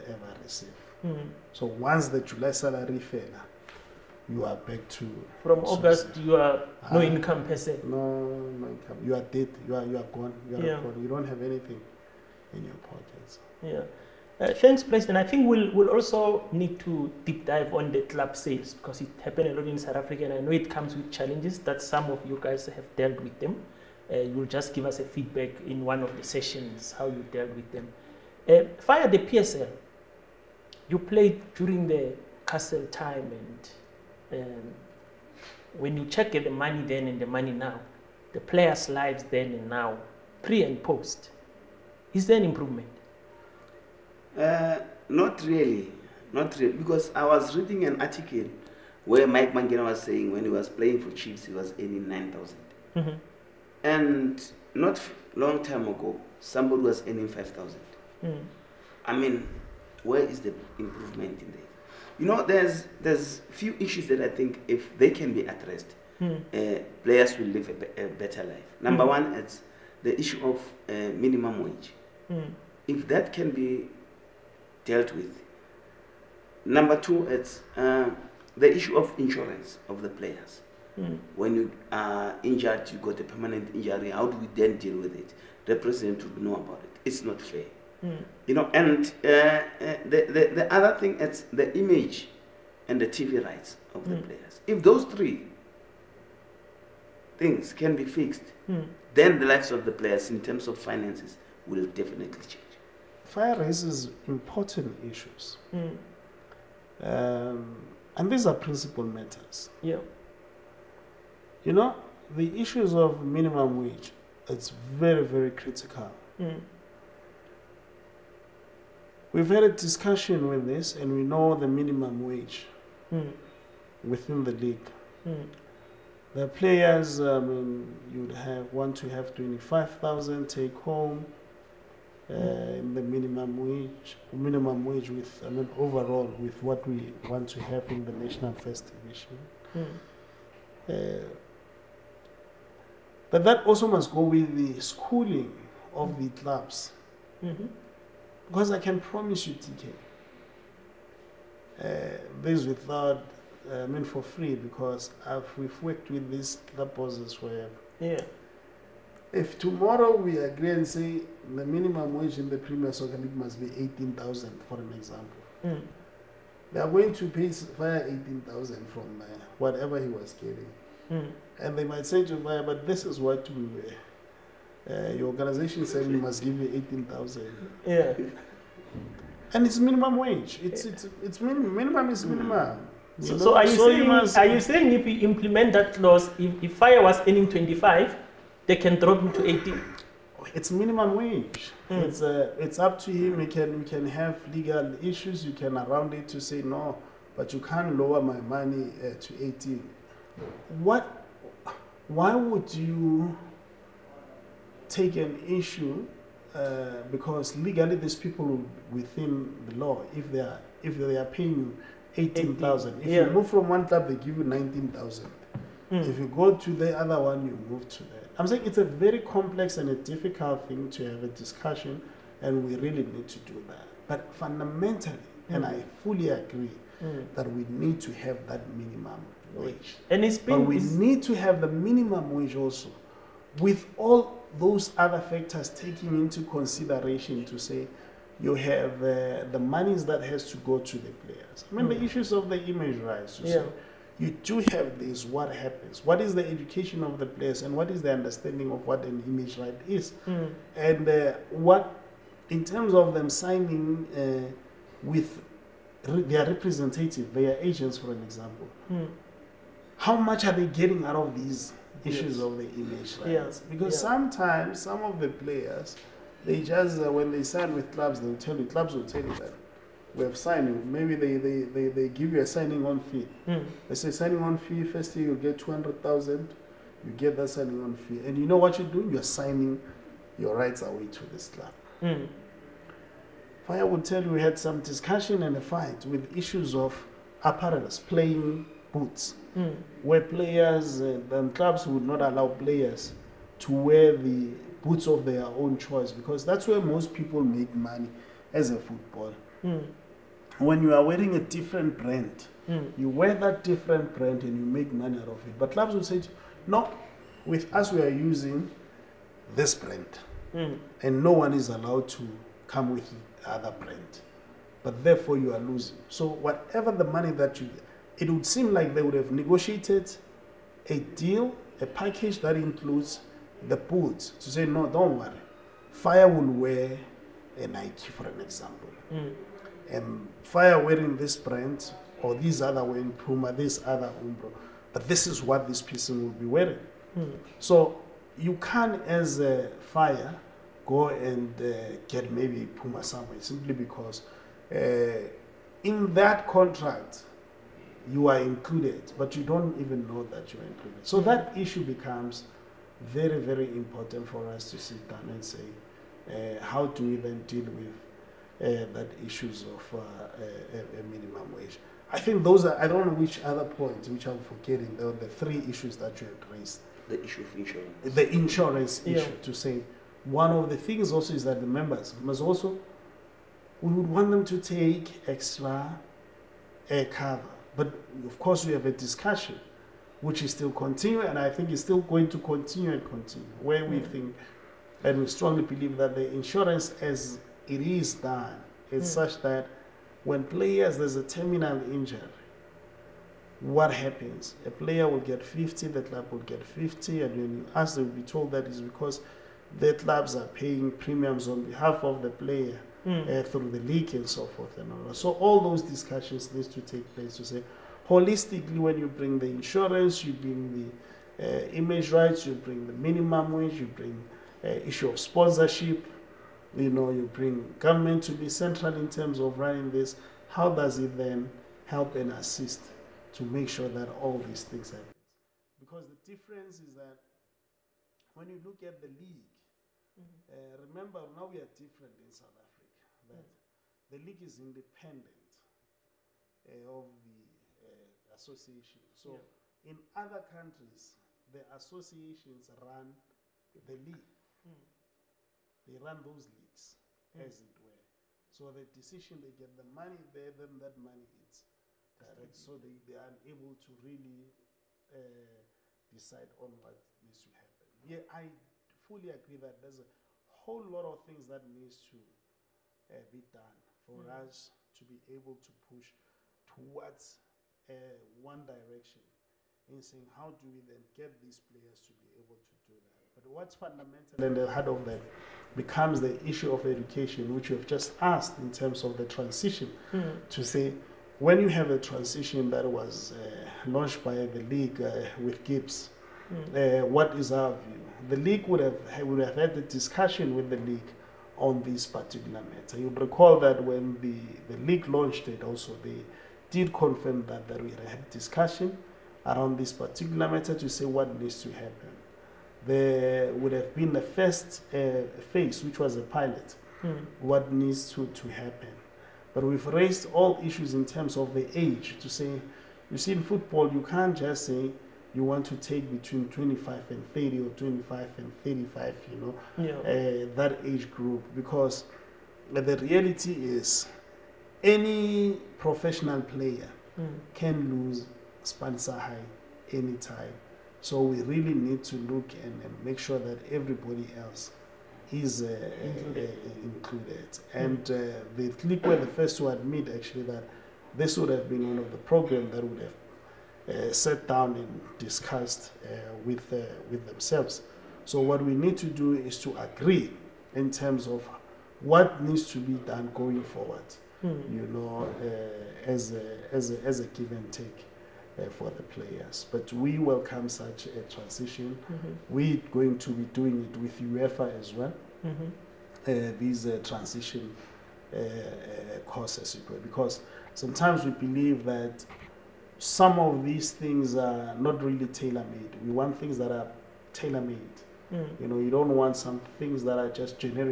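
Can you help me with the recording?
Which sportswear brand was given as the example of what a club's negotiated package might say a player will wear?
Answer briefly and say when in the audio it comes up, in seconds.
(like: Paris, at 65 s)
Nike, at 327 s.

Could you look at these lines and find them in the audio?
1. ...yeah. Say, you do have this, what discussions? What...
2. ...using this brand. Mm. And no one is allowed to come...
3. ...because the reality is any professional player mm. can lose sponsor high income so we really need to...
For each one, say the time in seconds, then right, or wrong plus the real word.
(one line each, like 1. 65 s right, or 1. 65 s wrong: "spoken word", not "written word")
1. 243 s wrong: "happens", not "discussions"
2. 308 s right
3. 521 s wrong: "anytime", not "income".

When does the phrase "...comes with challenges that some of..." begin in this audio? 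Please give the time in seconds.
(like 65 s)
20 s.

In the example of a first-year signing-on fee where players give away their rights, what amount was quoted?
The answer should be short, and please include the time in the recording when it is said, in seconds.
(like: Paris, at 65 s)
200,000, at 275 s.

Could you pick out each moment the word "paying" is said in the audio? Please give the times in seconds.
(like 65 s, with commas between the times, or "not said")
211 s, 400 s.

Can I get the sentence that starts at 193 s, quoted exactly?
We can we can have legal issues.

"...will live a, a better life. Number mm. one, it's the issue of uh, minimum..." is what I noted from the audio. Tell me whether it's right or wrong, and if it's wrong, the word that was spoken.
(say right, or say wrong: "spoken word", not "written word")
right.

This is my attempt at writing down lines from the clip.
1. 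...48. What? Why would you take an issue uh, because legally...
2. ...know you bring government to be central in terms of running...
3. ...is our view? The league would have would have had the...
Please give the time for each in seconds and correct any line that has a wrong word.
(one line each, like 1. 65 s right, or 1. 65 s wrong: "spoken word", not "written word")
1. 199 s wrong: "18", not "48"
2. 416 s right
3. 487 s right.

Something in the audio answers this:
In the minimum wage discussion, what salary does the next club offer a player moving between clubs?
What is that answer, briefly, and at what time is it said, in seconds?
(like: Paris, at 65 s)
19,000, at 214 s.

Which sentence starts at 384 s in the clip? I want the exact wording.
think and we strongly believe that the insurance as it is done.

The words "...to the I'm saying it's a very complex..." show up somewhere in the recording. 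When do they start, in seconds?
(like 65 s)
217 s.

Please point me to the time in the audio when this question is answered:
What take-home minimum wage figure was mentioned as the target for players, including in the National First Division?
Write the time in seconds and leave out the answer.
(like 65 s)
129 s.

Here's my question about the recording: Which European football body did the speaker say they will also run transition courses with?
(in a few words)
UEFA.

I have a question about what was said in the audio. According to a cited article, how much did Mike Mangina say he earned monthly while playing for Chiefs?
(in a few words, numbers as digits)
9,000.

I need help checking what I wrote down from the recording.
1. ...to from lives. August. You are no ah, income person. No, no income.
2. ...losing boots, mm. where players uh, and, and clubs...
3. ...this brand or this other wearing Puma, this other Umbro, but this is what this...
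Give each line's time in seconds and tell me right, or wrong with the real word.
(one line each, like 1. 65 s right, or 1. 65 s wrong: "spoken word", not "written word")
1. 4 s wrong: "sources", not "lives"
2. 287 s wrong: "playing", not "losing"
3. 331 s right.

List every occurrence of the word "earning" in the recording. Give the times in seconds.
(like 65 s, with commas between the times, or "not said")
51 s, 57 s, 187 s.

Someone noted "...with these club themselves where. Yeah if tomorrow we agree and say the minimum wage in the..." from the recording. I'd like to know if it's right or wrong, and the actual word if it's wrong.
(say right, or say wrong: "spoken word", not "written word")
wrong: "bosses", not "themselves".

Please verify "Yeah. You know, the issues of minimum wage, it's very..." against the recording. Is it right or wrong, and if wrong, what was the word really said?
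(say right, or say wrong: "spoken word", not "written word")
right.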